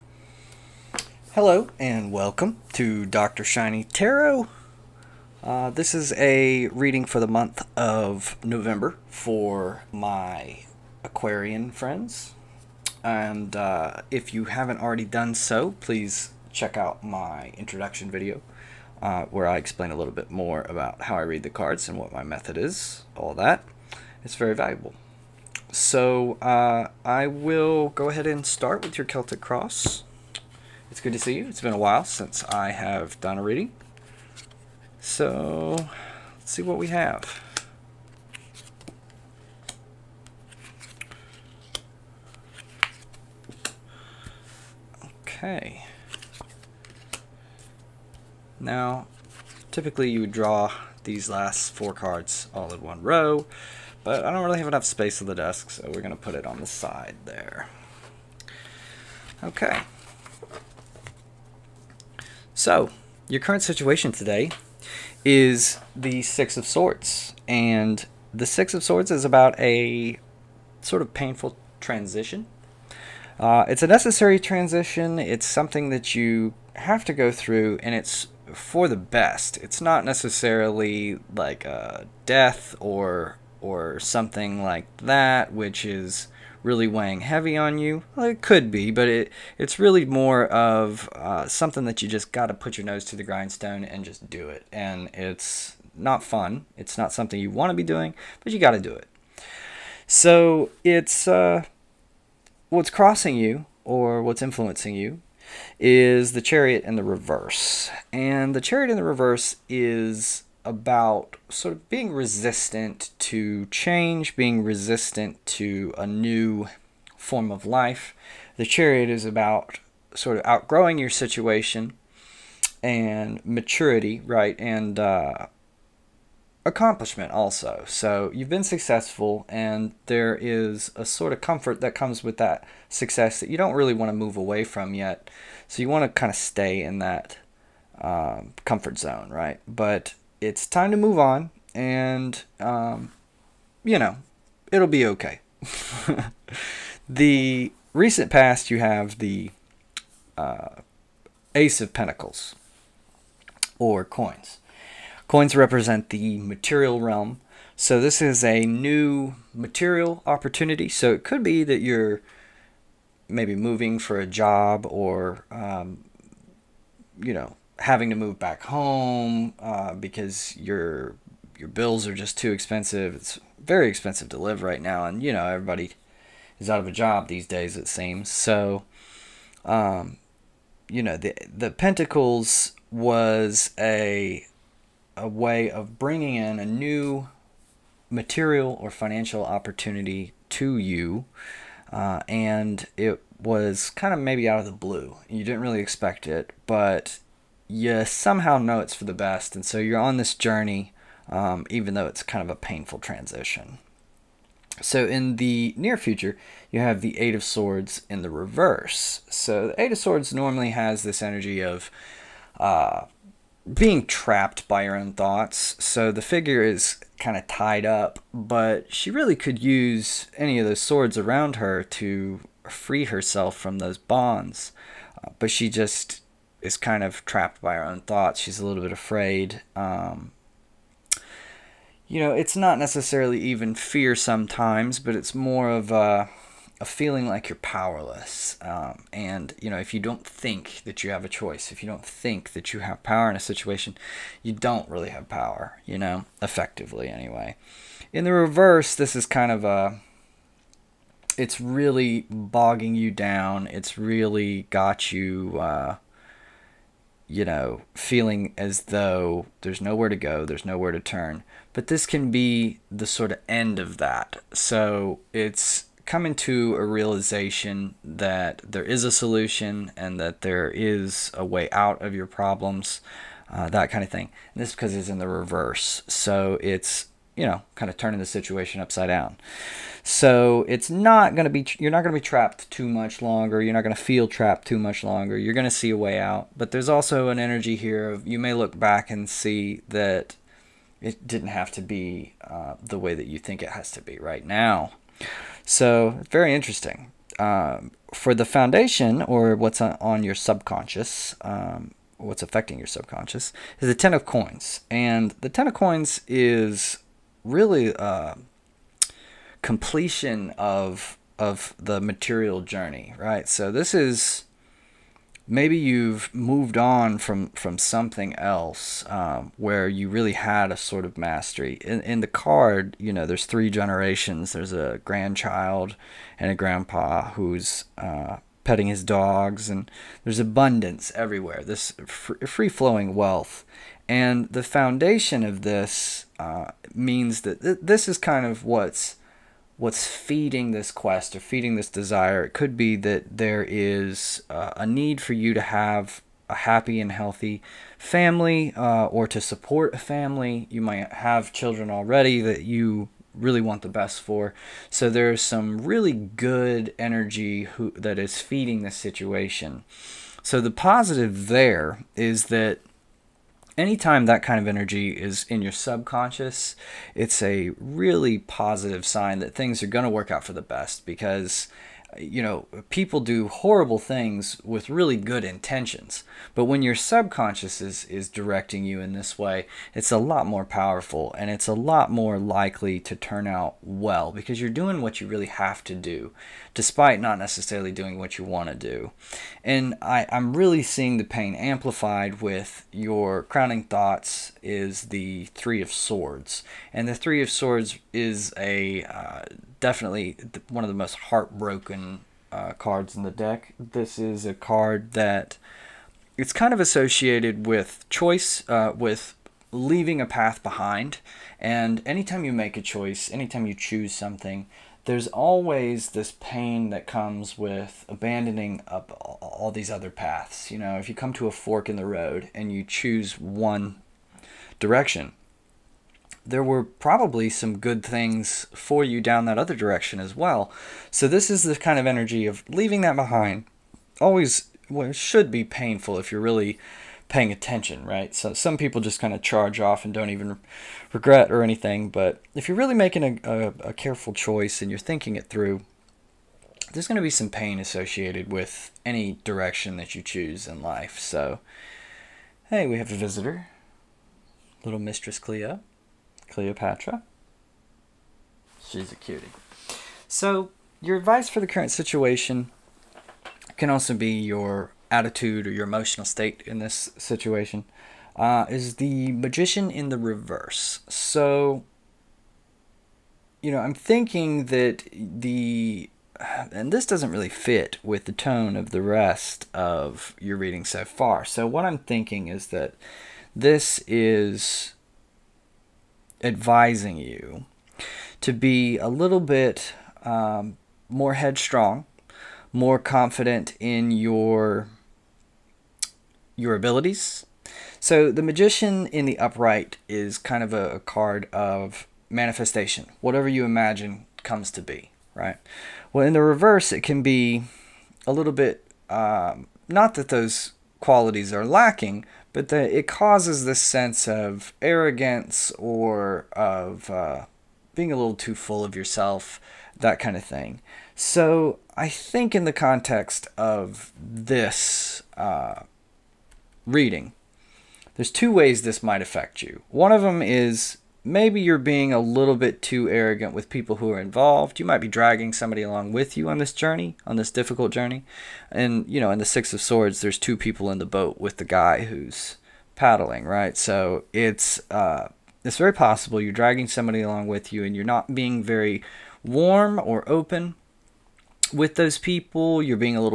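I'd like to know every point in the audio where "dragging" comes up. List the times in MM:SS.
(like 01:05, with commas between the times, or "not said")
08:55, 09:06.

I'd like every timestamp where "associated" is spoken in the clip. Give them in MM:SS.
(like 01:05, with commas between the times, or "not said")
06:46, 07:27.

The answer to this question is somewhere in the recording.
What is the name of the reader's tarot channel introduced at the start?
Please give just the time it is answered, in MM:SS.
00:03.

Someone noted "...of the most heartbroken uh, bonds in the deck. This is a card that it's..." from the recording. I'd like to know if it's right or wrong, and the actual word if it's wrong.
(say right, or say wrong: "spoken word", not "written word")
wrong: "cards", not "bonds".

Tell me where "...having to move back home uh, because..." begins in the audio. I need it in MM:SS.
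02:47.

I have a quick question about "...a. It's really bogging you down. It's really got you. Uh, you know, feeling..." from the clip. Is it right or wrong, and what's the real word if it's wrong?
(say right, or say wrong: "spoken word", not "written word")
right.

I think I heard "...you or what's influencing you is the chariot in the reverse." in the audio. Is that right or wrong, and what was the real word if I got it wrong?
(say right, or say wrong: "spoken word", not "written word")
right.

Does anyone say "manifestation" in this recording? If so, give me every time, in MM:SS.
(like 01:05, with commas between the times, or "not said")
08:22.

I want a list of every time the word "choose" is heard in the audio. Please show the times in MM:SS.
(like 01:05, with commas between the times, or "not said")
06:53, 07:02, 07:30.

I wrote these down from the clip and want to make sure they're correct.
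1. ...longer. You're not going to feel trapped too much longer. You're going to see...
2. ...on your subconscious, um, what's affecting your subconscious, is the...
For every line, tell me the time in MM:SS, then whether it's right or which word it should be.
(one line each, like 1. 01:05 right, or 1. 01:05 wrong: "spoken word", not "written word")
1. 04:43 right
2. 04:59 right.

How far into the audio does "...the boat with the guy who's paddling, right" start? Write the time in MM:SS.
09:00.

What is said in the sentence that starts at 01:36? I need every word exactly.
It's not something you want to be doing, but you got to do it.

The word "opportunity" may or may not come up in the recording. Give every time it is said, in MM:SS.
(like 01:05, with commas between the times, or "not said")
02:40, 03:09.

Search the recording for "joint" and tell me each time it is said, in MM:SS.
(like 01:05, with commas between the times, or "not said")
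not said.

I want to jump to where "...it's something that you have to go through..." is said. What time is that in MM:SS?
01:15.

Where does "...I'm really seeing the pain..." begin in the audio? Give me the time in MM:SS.
06:30.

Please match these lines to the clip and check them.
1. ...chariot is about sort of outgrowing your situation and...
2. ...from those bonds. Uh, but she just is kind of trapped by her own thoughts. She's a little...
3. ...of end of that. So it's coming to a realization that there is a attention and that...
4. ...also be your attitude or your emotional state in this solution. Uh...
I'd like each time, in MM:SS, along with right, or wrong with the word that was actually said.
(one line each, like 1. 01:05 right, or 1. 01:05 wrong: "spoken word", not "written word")
1. 01:58 right
2. 03:43 right
3. 04:23 wrong: "solution", not "attention"
4. 07:43 wrong: "situation", not "solution".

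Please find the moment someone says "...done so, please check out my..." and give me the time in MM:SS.
00:15.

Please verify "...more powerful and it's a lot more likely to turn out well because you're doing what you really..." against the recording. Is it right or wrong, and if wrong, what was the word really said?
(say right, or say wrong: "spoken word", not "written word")
right.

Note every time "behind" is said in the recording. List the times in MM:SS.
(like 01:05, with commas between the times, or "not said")
06:50, 07:13.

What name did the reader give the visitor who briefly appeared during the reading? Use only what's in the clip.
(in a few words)
Cleopatra.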